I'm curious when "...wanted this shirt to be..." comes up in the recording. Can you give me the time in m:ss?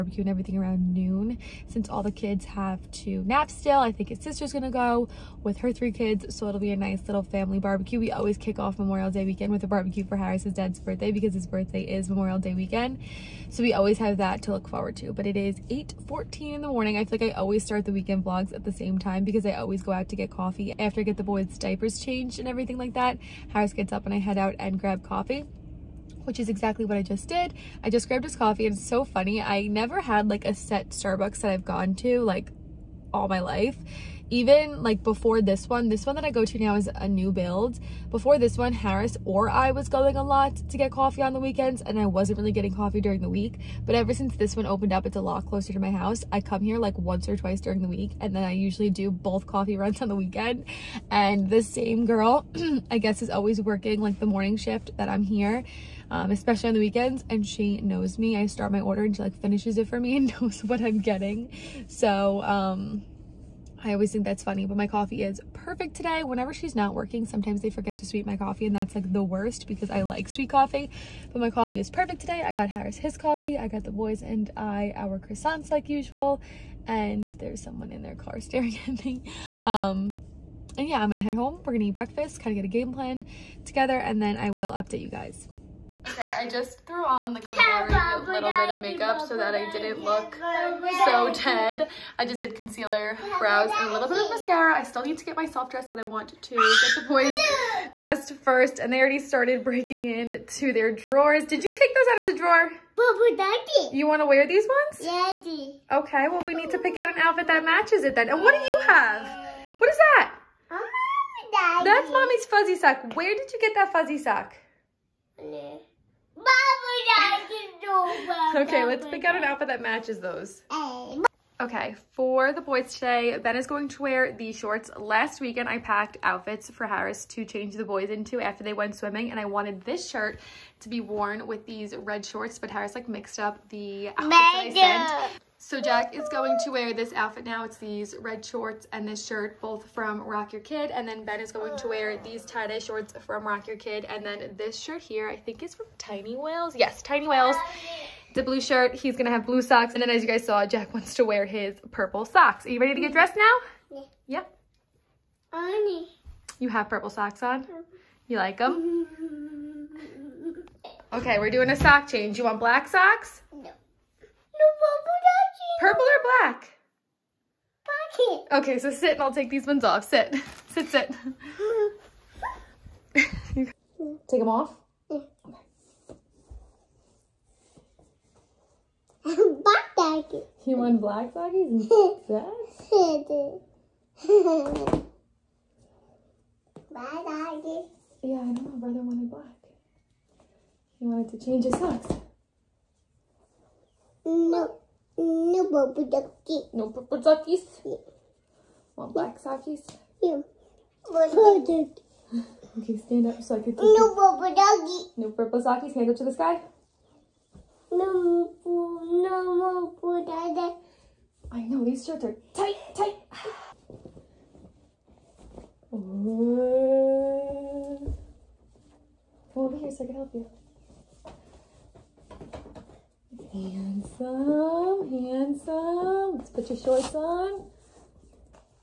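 2:09.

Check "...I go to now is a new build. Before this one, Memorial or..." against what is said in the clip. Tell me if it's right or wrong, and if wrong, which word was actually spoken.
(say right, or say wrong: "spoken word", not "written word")
wrong: "Harris", not "Memorial".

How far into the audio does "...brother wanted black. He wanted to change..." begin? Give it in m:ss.
3:08.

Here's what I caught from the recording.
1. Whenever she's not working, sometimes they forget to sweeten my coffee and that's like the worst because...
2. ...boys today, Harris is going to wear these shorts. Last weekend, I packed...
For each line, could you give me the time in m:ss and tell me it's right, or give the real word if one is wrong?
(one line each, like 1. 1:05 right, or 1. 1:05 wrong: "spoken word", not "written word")
1. 1:06 right
2. 2:02 wrong: "Ben", not "Harris".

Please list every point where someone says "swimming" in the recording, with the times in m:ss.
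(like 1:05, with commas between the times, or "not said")
2:08.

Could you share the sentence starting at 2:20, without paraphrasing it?
And then Ben is going to wear these tie-dye shorts from Rock Your Kid.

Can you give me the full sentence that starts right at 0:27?
I just grabbed his coffee and it's so funny.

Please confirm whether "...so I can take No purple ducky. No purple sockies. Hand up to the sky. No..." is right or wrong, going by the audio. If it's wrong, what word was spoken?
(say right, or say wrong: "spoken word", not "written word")
right.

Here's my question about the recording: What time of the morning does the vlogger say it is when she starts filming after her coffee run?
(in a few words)
8:14.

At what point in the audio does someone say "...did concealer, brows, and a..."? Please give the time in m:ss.
1:32.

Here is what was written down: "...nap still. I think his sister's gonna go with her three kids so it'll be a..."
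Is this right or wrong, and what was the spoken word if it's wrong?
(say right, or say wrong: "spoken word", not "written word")
right.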